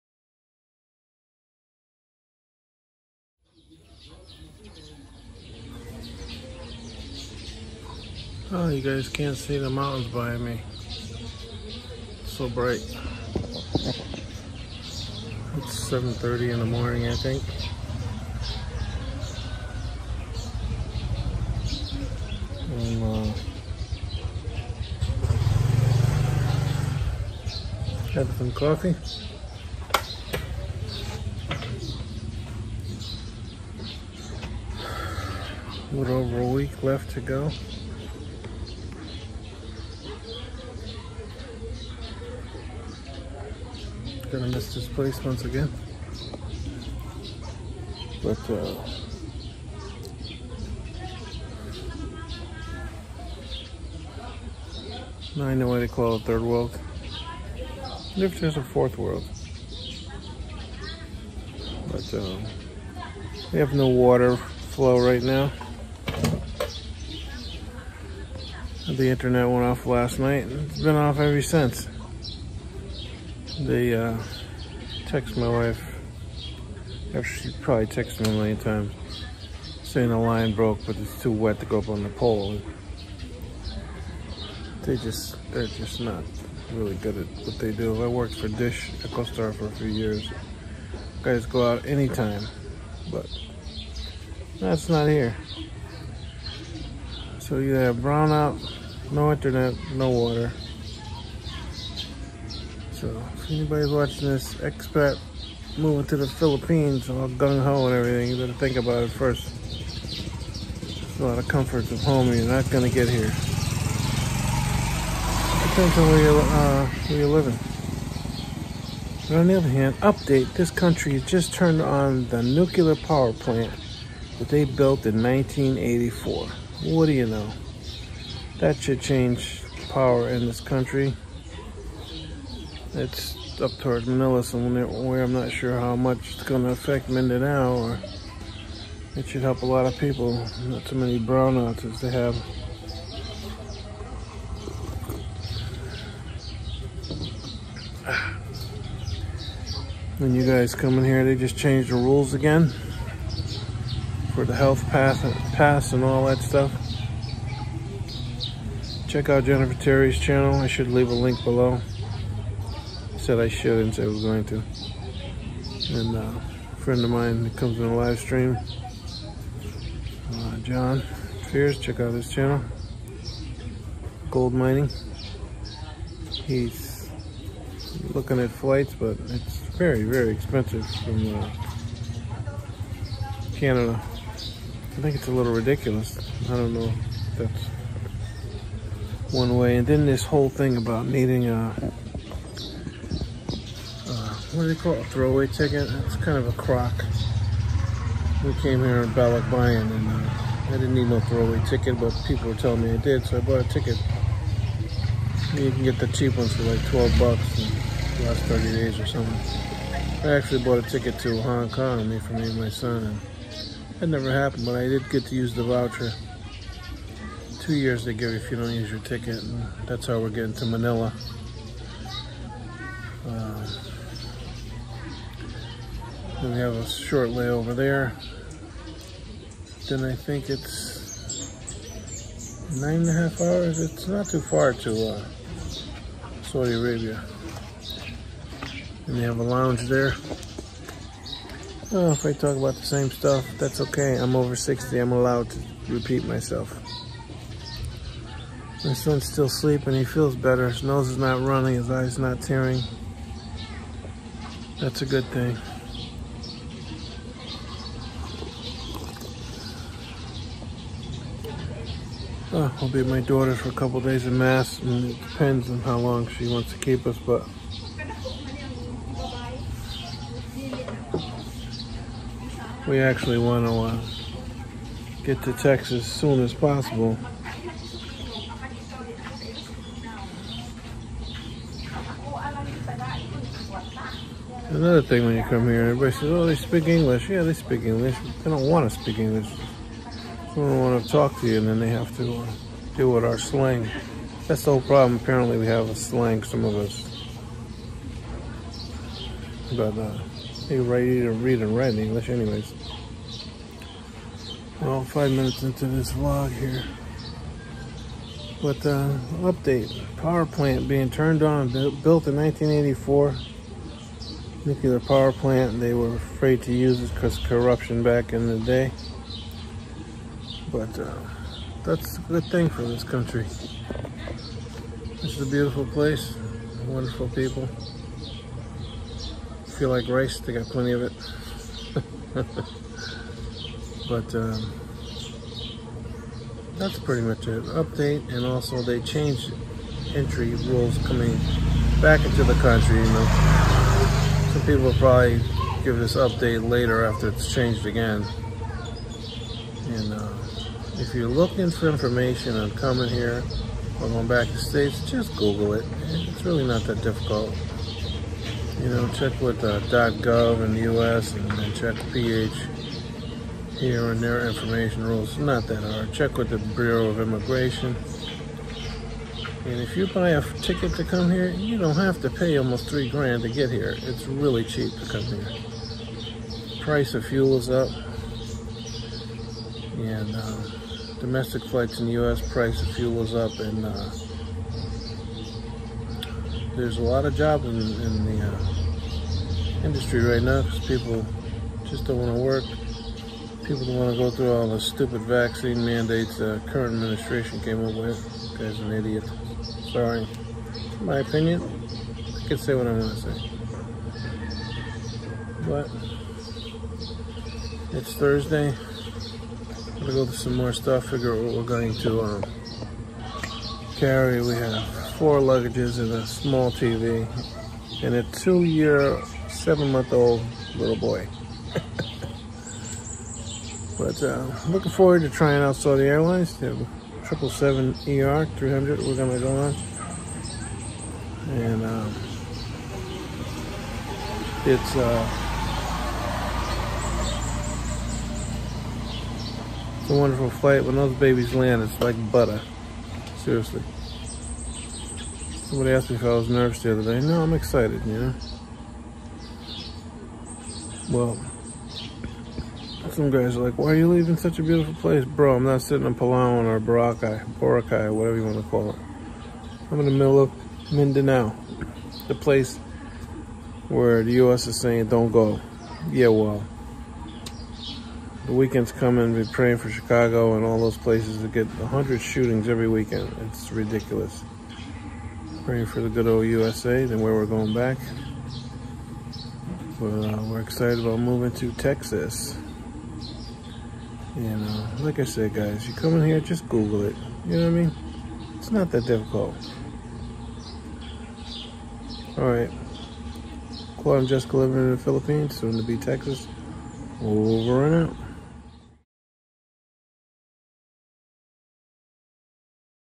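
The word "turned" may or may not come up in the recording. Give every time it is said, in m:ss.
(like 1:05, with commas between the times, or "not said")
2:01, 5:11.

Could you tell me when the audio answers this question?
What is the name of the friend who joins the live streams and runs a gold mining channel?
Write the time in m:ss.
2:50.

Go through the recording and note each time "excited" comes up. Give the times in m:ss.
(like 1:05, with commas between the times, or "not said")
7:27, 8:00.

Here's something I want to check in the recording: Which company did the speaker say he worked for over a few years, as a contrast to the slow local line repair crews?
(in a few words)
Dish.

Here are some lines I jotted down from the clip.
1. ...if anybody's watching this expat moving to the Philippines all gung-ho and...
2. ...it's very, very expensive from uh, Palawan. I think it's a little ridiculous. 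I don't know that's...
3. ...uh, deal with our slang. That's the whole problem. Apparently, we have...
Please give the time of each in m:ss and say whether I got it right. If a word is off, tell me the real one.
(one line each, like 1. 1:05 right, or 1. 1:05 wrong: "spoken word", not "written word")
1. 1:43 right
2. 2:59 wrong: "Canada", not "Palawan"
3. 4:52 right.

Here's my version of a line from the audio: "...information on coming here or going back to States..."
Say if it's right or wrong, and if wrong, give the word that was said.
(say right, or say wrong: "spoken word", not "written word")
right.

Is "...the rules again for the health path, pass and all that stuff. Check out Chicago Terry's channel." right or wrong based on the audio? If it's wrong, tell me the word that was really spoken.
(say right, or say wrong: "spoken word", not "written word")
wrong: "Jennifer", not "Chicago".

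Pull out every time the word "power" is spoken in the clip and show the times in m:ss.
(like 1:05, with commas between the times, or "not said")
2:02, 2:09, 5:10, 5:14.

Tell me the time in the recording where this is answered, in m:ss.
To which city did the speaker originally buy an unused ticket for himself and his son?
3:31.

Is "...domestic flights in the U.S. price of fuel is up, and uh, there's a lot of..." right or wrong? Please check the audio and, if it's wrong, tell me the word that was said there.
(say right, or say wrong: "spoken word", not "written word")
right.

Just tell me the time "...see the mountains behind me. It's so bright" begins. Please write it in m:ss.
0:09.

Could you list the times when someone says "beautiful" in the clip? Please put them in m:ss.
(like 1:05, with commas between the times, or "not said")
5:25, 7:34.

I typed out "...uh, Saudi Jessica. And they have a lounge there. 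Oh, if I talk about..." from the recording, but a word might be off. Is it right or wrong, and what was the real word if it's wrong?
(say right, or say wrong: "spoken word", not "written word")
wrong: "Arabia", not "Jessica".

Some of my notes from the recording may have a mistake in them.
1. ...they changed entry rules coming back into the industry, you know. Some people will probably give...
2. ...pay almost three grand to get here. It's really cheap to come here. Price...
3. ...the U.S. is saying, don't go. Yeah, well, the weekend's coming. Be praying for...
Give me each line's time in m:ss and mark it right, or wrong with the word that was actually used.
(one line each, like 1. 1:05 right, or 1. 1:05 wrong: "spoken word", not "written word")
1. 5:38 wrong: "country", not "industry"
2. 6:12 right
3. 7:44 right.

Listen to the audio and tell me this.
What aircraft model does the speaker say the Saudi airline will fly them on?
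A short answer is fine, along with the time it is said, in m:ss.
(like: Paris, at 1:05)
777ER 300, at 7:07.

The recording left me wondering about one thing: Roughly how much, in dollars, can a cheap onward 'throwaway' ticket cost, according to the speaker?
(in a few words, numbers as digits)
$12.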